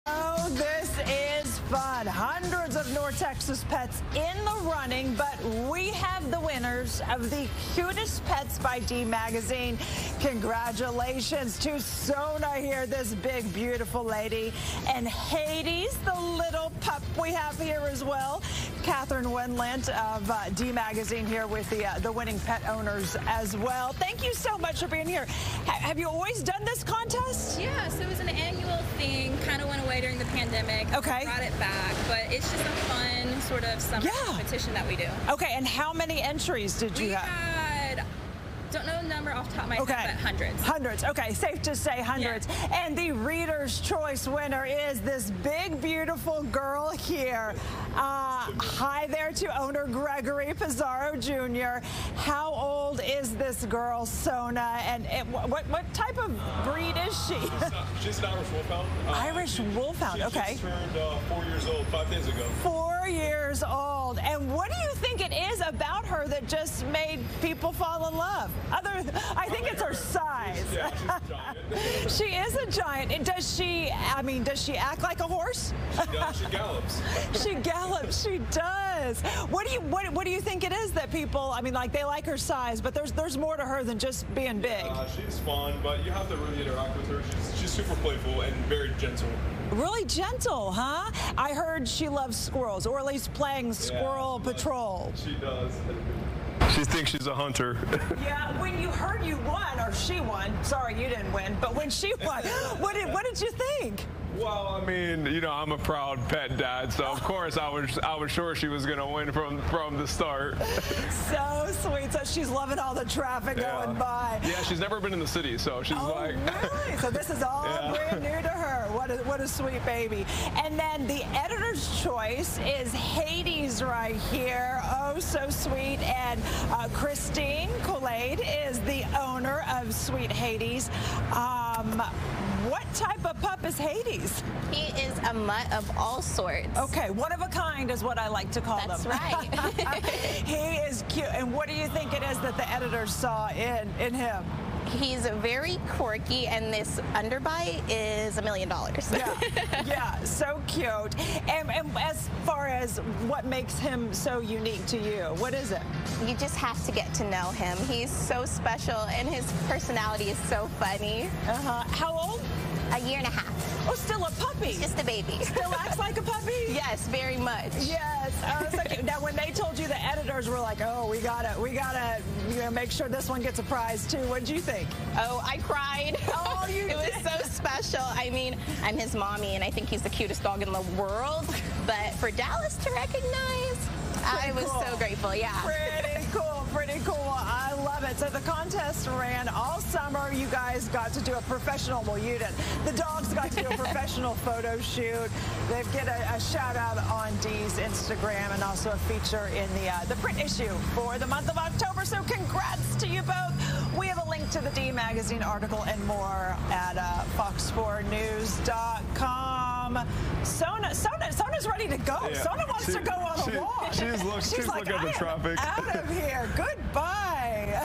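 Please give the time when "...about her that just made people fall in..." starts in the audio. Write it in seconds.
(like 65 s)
65 s.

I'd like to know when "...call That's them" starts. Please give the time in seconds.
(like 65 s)
138 s.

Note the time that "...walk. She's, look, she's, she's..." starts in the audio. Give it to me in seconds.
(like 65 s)
213 s.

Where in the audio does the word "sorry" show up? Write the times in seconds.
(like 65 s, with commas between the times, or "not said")
100 s.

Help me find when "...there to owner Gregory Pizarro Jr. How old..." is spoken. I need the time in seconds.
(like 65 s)
49 s.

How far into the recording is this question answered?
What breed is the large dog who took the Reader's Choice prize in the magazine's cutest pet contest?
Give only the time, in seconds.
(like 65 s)
58 s.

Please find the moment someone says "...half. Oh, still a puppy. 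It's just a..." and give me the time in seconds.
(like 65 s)
163 s.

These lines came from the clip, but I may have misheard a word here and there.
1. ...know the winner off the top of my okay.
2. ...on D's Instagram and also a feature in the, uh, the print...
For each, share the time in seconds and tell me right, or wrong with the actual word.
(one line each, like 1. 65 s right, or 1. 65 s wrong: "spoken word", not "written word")
1. 38 s wrong: "number", not "winner"
2. 197 s right.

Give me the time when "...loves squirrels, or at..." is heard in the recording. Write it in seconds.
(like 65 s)
92 s.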